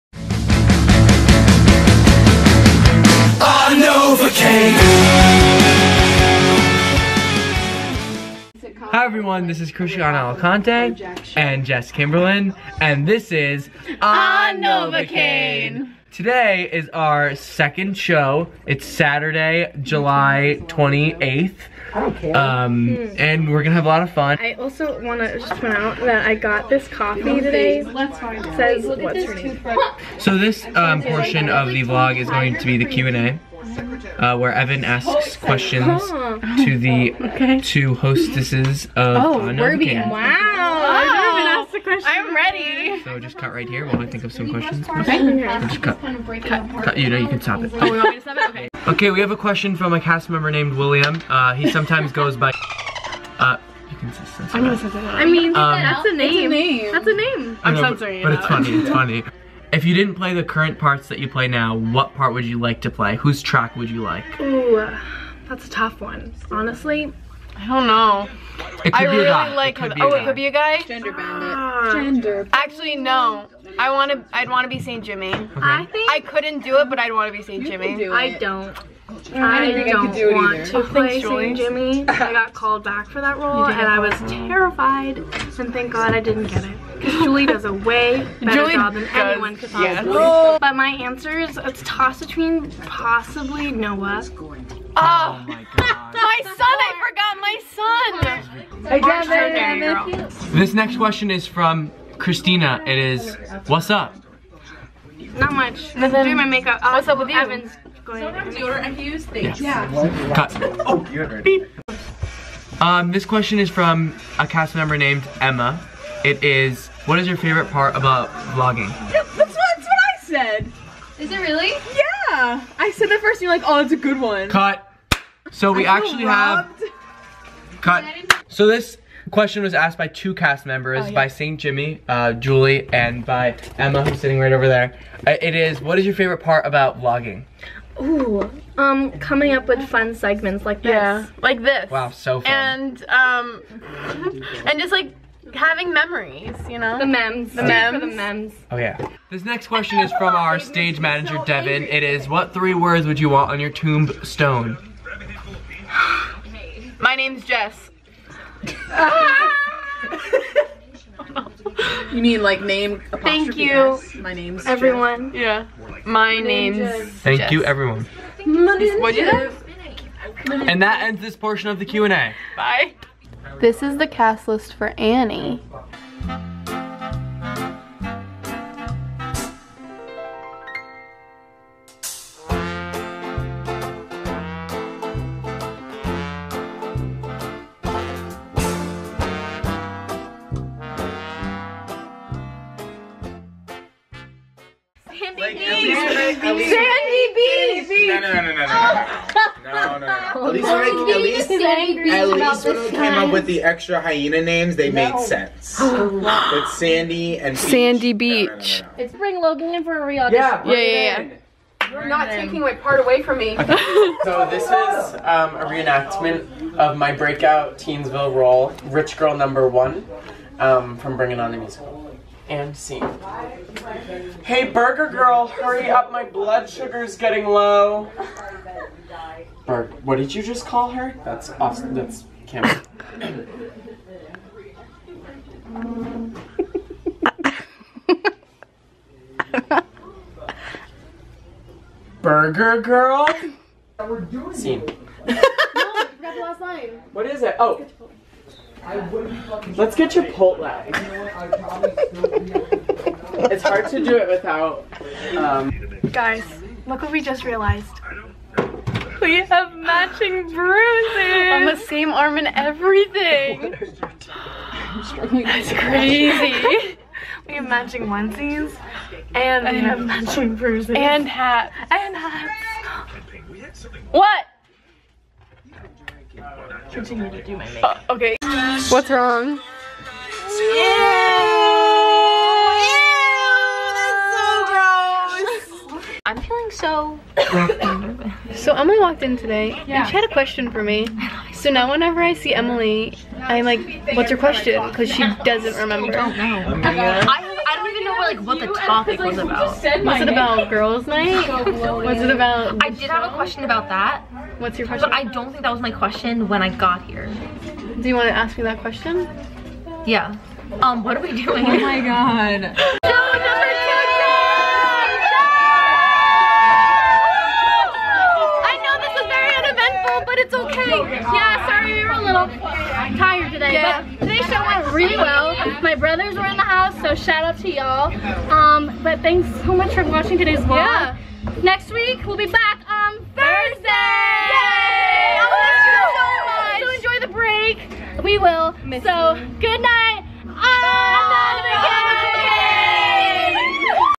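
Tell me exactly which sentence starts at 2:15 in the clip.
Uh, it is, what is your favorite part about vlogging?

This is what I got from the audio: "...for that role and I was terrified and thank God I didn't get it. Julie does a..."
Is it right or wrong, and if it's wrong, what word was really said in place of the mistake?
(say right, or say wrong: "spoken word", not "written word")
right.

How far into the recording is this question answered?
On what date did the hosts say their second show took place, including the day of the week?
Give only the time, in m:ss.
0:18.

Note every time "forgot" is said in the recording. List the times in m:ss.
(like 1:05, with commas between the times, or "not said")
1:38, 4:06.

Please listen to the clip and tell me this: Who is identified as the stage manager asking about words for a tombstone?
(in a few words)
Devin.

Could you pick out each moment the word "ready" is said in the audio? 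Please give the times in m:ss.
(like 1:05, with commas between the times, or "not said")
0:42.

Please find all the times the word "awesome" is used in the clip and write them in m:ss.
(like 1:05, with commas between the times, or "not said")
3:51.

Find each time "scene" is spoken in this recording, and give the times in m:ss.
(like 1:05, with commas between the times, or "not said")
3:42, 4:04.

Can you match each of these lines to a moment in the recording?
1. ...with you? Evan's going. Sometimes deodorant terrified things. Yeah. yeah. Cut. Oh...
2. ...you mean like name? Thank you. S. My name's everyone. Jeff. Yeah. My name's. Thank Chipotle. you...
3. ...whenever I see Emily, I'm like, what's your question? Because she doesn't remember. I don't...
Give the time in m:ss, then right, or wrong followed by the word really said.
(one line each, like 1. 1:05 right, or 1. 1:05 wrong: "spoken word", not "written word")
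1. 1:47 wrong: "infused", not "terrified"
2. 2:42 wrong: "Jess", not "Chipotle"
3. 4:51 right.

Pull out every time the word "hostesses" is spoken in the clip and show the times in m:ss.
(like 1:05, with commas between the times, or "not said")
0:37.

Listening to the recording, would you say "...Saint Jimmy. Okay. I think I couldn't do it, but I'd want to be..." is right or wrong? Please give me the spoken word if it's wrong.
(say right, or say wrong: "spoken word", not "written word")
right.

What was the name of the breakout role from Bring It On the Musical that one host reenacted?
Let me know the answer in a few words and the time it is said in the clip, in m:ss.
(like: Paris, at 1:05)
Rich Girl Number One, at 3:38.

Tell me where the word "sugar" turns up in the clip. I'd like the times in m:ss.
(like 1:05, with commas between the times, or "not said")
3:46.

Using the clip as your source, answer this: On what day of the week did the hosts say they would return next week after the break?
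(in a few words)
Thursday.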